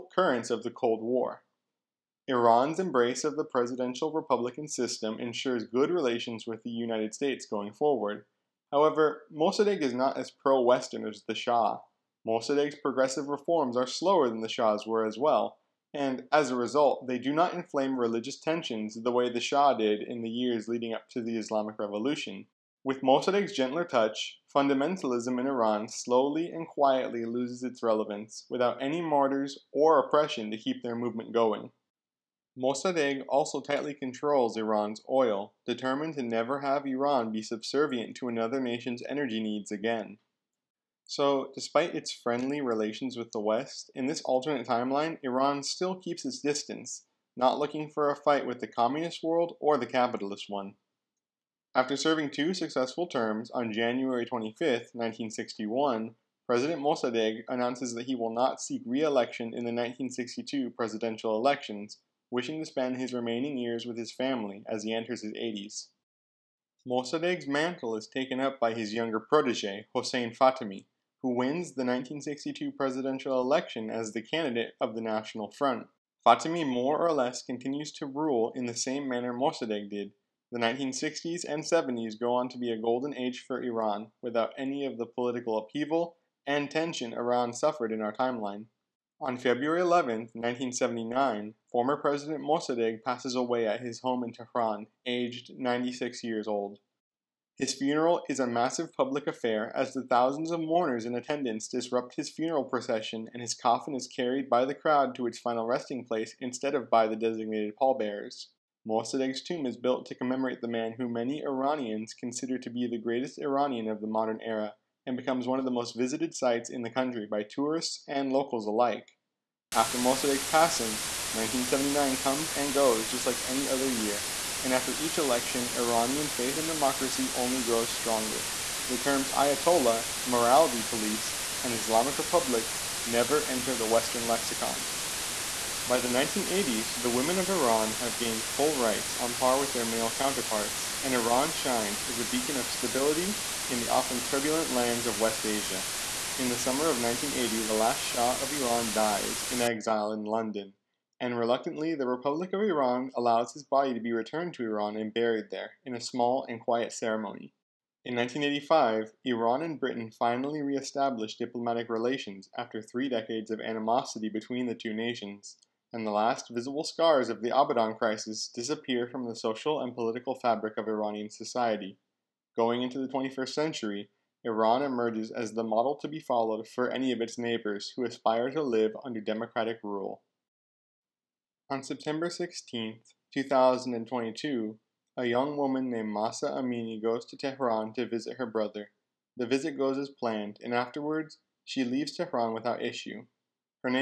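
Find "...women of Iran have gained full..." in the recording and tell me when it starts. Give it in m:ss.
2:17.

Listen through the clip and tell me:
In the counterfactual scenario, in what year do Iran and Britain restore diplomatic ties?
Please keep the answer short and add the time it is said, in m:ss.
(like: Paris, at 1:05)
1985, at 2:38.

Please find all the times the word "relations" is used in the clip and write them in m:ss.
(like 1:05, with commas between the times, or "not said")
0:05, 0:42, 2:41.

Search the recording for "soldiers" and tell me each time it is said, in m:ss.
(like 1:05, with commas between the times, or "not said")
not said.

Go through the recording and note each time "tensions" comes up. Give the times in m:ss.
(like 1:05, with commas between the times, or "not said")
0:18, 1:26.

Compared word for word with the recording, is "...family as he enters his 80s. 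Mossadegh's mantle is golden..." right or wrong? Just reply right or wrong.
wrong.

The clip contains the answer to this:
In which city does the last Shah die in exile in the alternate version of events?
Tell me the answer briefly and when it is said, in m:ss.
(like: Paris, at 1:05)
London, at 2:30.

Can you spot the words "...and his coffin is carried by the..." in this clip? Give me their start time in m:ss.
1:43.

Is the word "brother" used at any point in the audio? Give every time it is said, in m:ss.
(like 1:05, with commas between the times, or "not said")
3:08.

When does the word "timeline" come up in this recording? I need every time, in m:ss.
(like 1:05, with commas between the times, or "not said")
0:44, 1:28.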